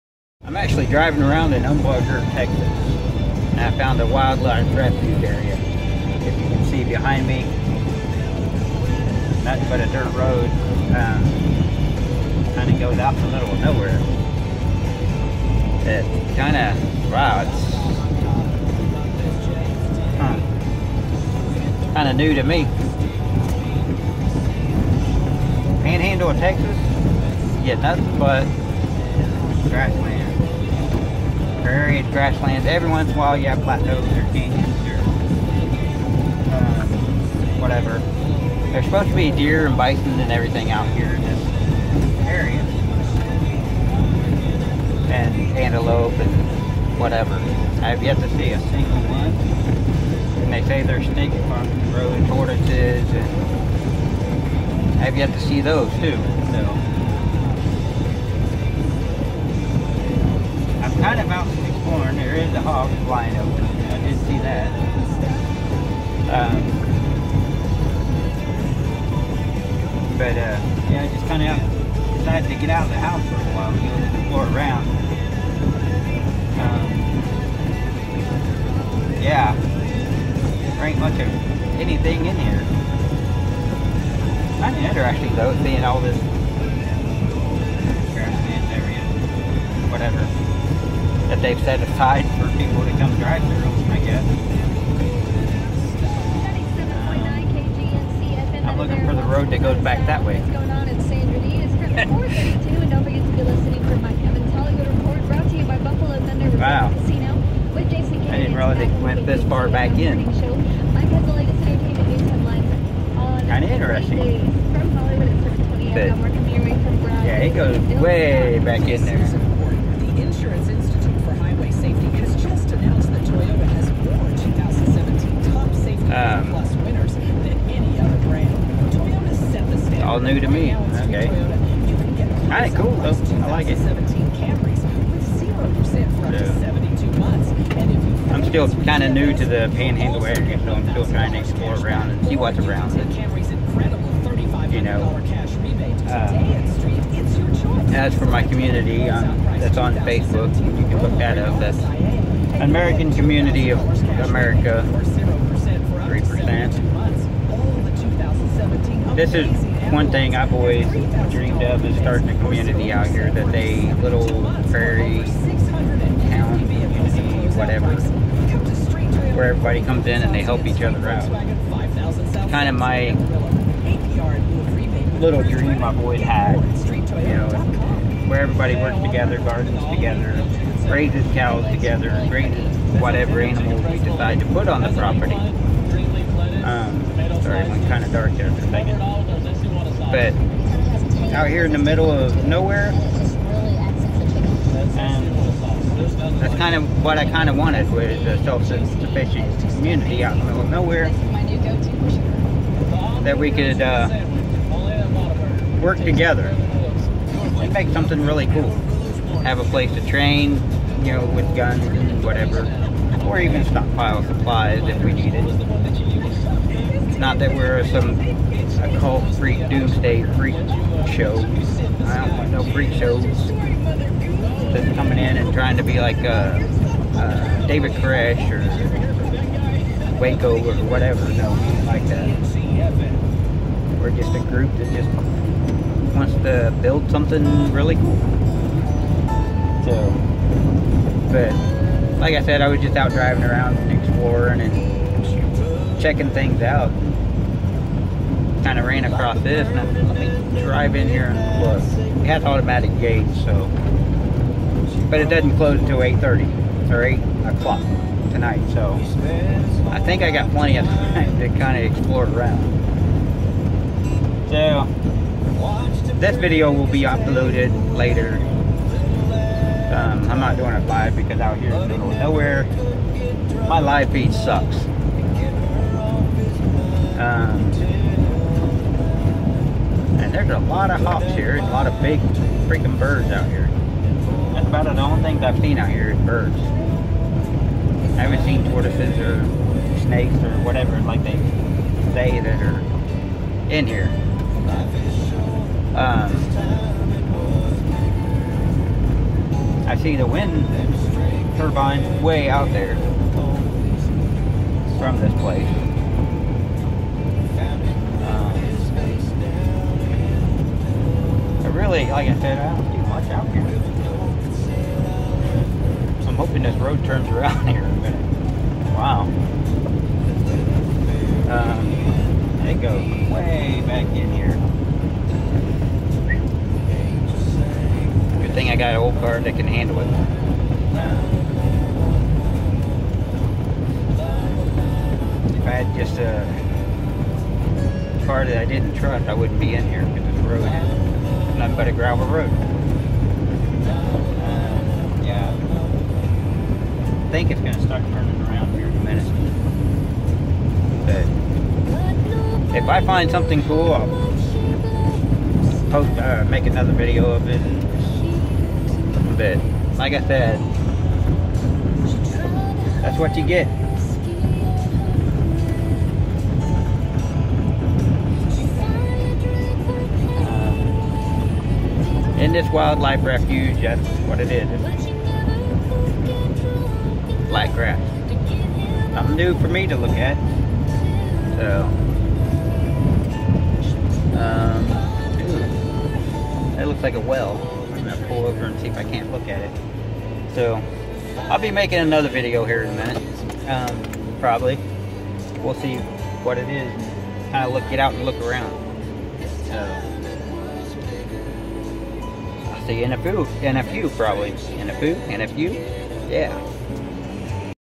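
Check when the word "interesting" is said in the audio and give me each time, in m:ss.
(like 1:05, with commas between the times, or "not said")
1:24, 1:53.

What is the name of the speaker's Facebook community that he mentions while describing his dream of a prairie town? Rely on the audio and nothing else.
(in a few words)
American Community of America.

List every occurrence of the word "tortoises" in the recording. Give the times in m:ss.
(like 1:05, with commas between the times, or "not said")
0:52, 4:48.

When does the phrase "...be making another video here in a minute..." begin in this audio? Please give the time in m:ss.
6:31.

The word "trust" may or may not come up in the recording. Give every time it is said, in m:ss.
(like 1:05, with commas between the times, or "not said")
5:38.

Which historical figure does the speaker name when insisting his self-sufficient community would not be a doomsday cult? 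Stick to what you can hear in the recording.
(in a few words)
David Koresh.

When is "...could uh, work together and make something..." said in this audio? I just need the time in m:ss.
3:23.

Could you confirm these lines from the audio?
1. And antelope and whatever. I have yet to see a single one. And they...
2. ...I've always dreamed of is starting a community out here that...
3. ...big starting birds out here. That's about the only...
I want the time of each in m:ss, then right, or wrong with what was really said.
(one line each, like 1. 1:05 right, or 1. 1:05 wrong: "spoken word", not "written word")
1. 0:45 right
2. 2:40 right
3. 4:42 wrong: "freaking", not "starting".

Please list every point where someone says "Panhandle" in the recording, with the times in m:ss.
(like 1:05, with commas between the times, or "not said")
0:25, 2:19.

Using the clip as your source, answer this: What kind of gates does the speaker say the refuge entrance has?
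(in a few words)
automatic.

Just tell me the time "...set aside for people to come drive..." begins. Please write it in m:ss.
1:31.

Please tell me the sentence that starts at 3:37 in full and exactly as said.
Not that we're some occult freak doomsday freak show.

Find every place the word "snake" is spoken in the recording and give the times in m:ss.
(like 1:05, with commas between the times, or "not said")
0:51, 4:49.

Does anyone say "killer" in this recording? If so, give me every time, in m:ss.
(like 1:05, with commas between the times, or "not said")
not said.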